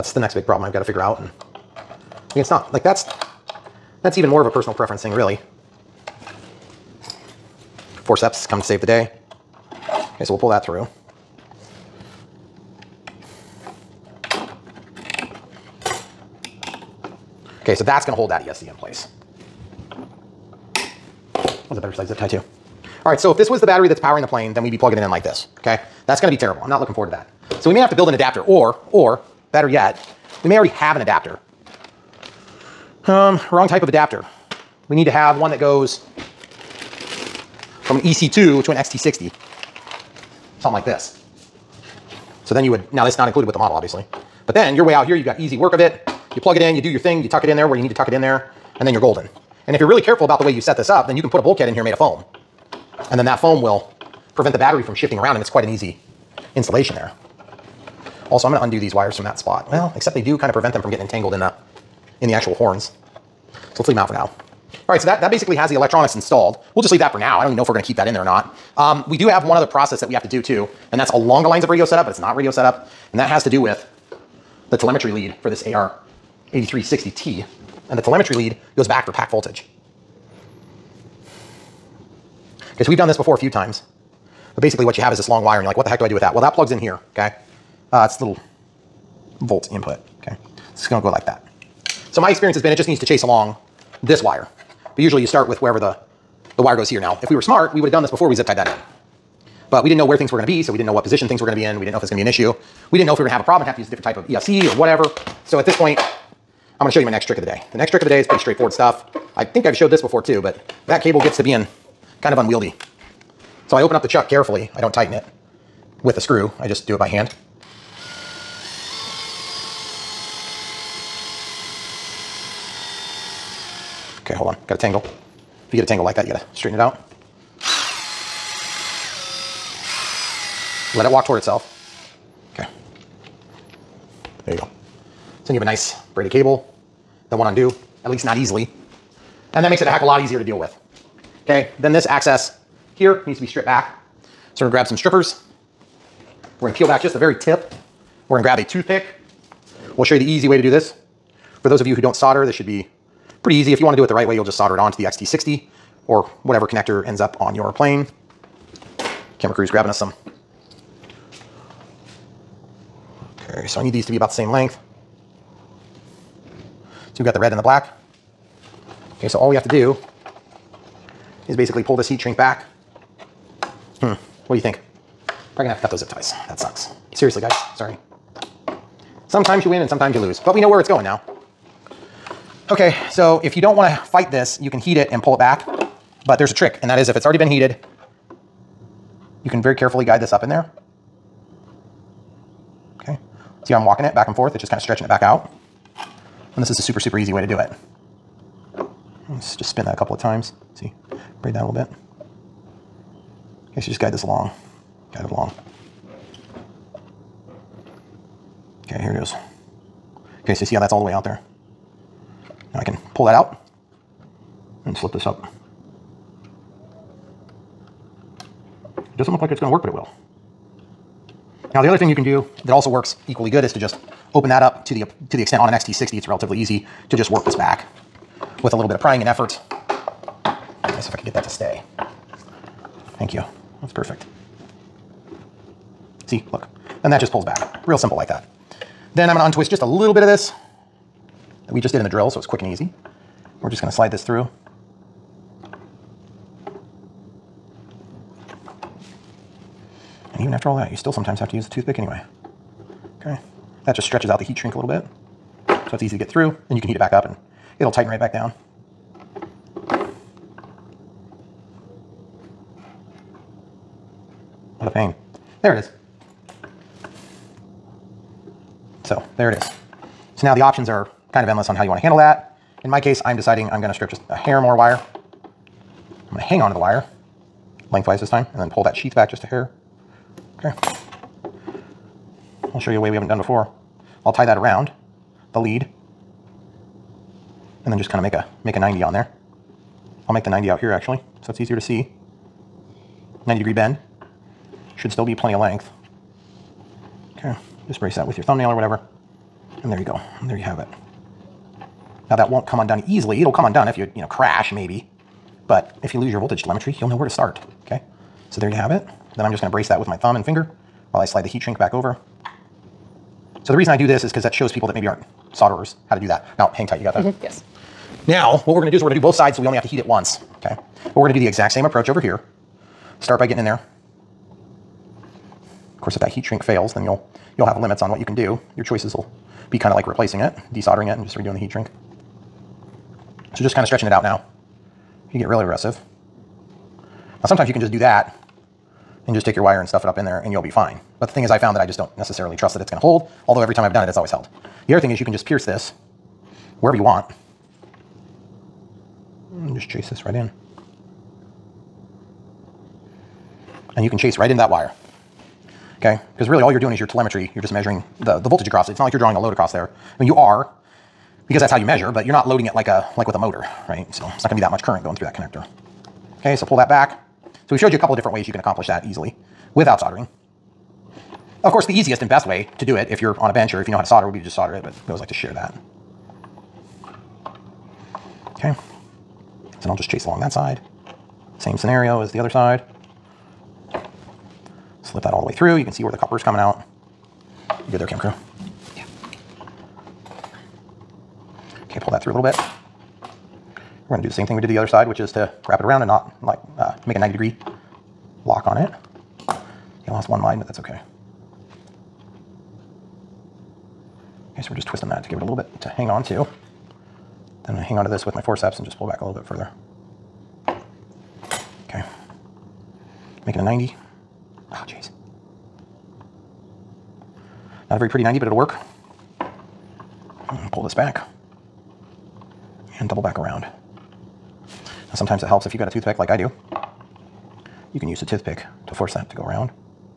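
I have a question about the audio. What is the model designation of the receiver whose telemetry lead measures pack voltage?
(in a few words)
AR 8360T.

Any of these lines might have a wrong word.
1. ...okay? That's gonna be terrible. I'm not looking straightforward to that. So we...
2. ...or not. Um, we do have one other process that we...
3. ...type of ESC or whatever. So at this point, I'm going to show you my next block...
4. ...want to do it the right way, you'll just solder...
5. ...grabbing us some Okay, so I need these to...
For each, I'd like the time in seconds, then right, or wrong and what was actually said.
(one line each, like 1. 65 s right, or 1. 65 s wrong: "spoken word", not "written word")
1. 25 s wrong: "forward", not "straightforward"
2. 68 s right
3. 104 s wrong: "trick", not "block"
4. 153 s right
5. 159 s right.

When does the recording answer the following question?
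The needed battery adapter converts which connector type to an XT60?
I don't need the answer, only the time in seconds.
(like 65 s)
38 s.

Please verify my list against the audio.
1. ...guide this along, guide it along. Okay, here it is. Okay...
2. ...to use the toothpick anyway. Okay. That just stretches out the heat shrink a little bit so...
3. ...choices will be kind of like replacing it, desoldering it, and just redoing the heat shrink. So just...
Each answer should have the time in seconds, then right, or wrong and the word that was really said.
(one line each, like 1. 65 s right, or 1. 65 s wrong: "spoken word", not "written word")
1. 203 s right
2. 251 s right
3. 328 s right.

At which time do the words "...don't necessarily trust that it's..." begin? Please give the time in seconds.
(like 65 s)
341 s.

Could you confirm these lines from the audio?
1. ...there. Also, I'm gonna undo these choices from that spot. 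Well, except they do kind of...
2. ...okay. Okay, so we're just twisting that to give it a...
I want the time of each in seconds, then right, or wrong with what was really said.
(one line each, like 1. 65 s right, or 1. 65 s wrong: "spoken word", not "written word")
1. 56 s wrong: "wires", not "choices"
2. 400 s right.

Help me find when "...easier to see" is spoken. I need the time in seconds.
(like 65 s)
291 s.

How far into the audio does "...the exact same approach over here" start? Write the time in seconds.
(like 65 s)
321 s.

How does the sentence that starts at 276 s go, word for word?
I'm gonna hang onto the wire lengthwise this time and then pull that sheath back just a hair.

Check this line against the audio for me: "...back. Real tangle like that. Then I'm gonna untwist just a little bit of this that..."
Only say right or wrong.
wrong.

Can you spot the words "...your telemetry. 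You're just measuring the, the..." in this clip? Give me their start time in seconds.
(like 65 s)
356 s.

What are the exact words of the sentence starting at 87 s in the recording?
Uh, it's little volt input, okay?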